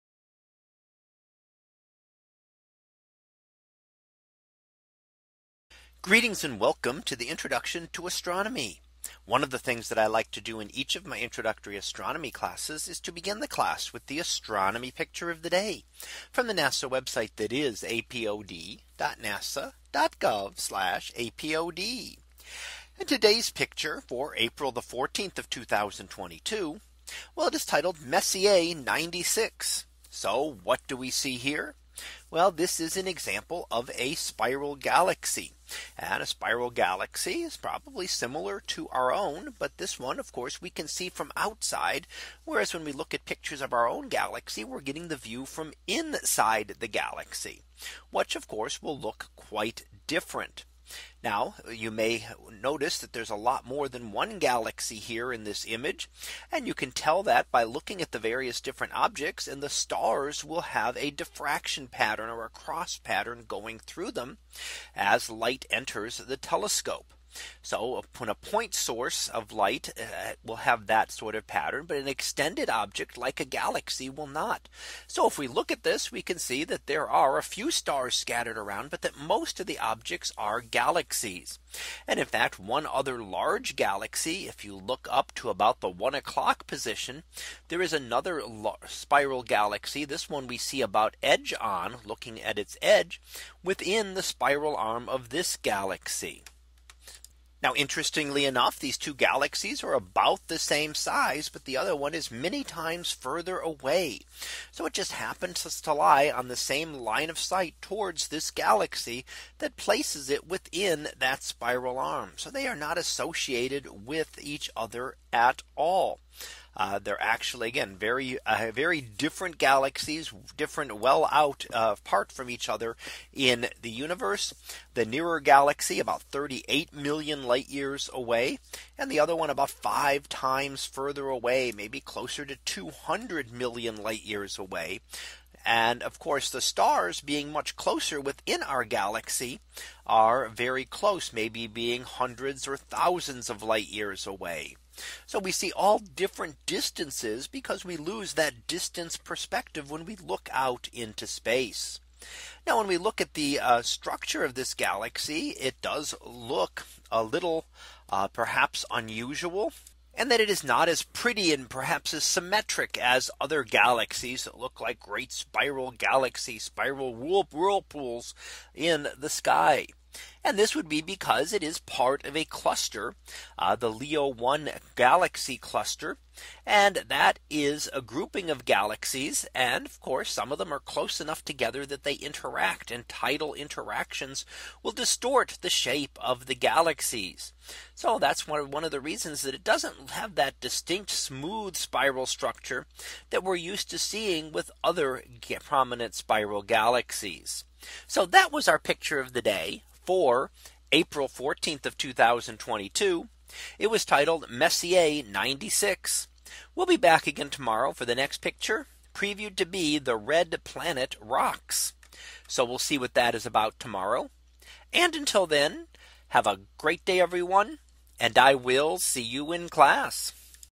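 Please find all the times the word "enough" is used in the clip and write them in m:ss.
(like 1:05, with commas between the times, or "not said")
1:38, 3:01.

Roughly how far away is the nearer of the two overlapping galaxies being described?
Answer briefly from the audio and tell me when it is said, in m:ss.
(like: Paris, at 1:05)
38 million light years, at 2:06.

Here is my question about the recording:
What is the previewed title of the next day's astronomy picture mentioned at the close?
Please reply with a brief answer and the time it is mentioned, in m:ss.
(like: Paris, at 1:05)
The Red Planet Rocks, at 3:29.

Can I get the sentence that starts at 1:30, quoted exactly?
This one we see about edge on looking at its edge within the spiral arm of this galaxy.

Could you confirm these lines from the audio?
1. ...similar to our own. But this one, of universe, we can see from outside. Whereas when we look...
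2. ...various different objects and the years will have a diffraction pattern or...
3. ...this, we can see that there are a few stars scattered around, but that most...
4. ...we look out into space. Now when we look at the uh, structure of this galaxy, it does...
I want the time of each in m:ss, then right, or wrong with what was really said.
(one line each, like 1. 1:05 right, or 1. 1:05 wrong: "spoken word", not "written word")
1. 0:38 wrong: "course", not "universe"
2. 0:58 wrong: "stars", not "years"
3. 1:15 right
4. 2:30 right.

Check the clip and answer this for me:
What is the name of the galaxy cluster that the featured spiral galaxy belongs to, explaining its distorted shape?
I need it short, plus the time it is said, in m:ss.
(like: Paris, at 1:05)
Leo 1 galaxy cluster, at 2:53.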